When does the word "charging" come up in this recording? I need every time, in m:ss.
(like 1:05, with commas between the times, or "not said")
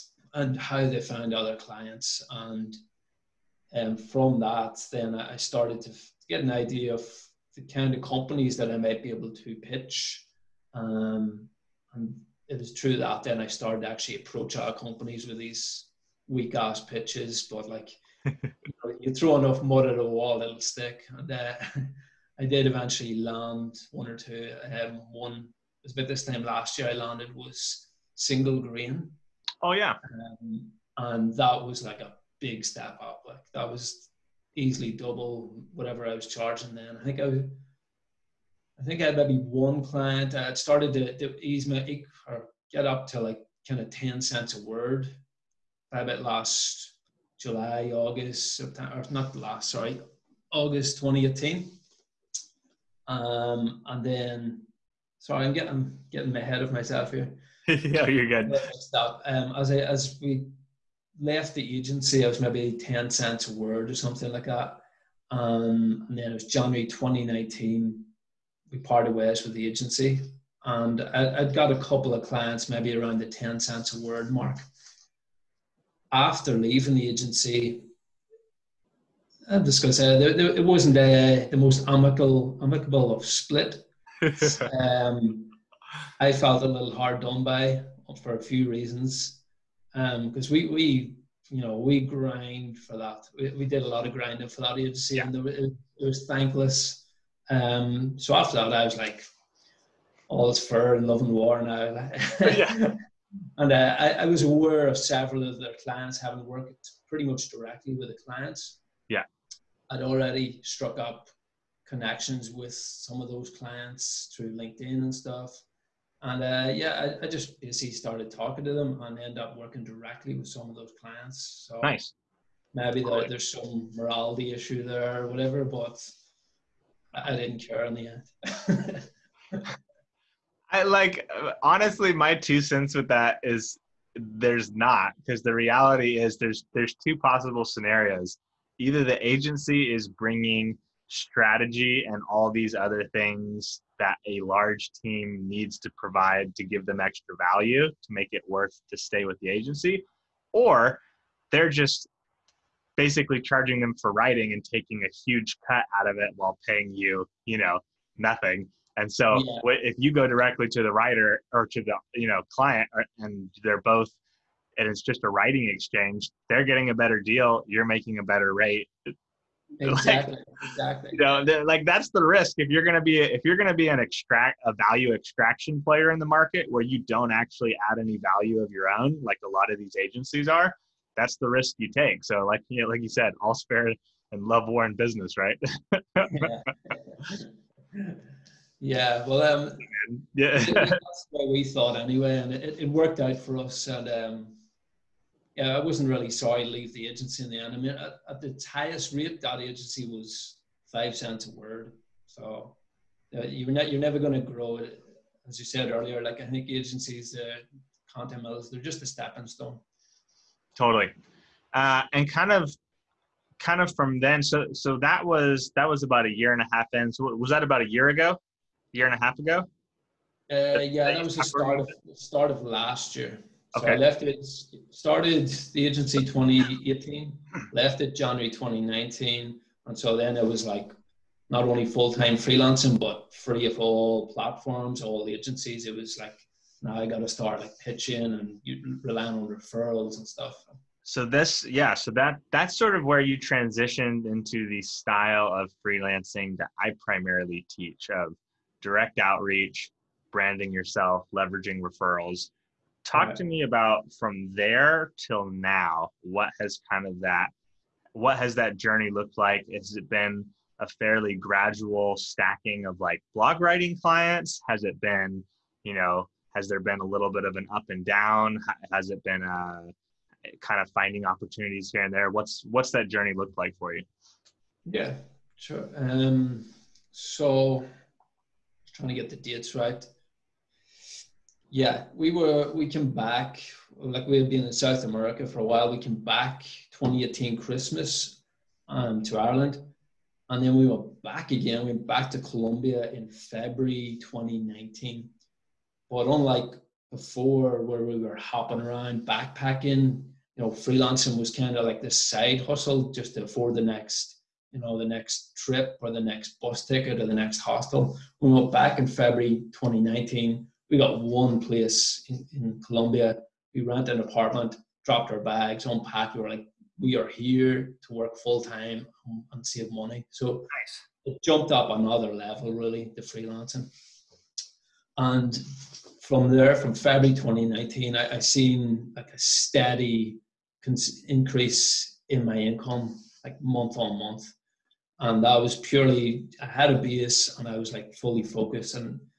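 0:36, 2:33.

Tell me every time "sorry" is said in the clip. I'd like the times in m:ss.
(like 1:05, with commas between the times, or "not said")
0:49, 0:55, 3:16.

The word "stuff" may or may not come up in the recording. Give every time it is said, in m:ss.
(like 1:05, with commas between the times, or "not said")
1:55, 4:00.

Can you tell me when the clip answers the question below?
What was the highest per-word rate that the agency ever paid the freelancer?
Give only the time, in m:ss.
3:20.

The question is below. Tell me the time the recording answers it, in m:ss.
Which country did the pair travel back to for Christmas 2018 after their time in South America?
4:49.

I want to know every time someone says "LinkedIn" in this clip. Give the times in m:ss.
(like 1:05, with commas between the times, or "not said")
1:54.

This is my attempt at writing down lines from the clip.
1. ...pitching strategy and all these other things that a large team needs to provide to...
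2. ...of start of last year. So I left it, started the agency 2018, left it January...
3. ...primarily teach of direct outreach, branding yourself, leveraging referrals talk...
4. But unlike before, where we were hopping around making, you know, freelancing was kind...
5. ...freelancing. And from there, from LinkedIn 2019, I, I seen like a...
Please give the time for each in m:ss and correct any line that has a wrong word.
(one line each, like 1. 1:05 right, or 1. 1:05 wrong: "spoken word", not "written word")
1. 2:20 wrong: "bringing", not "pitching"
2. 3:41 right
3. 4:06 right
4. 4:56 wrong: "backpacking", not "making"
5. 5:23 wrong: "February", not "LinkedIn".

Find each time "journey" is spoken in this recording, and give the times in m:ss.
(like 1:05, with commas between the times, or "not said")
4:18, 4:33.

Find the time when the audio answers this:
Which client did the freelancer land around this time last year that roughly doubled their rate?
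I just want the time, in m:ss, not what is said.
0:28.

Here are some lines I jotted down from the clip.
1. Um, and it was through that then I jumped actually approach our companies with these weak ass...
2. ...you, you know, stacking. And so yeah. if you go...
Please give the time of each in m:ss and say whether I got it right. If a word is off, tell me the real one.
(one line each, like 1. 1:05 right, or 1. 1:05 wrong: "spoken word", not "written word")
1. 0:10 wrong: "started", not "jumped"
2. 2:36 wrong: "nothing", not "stacking".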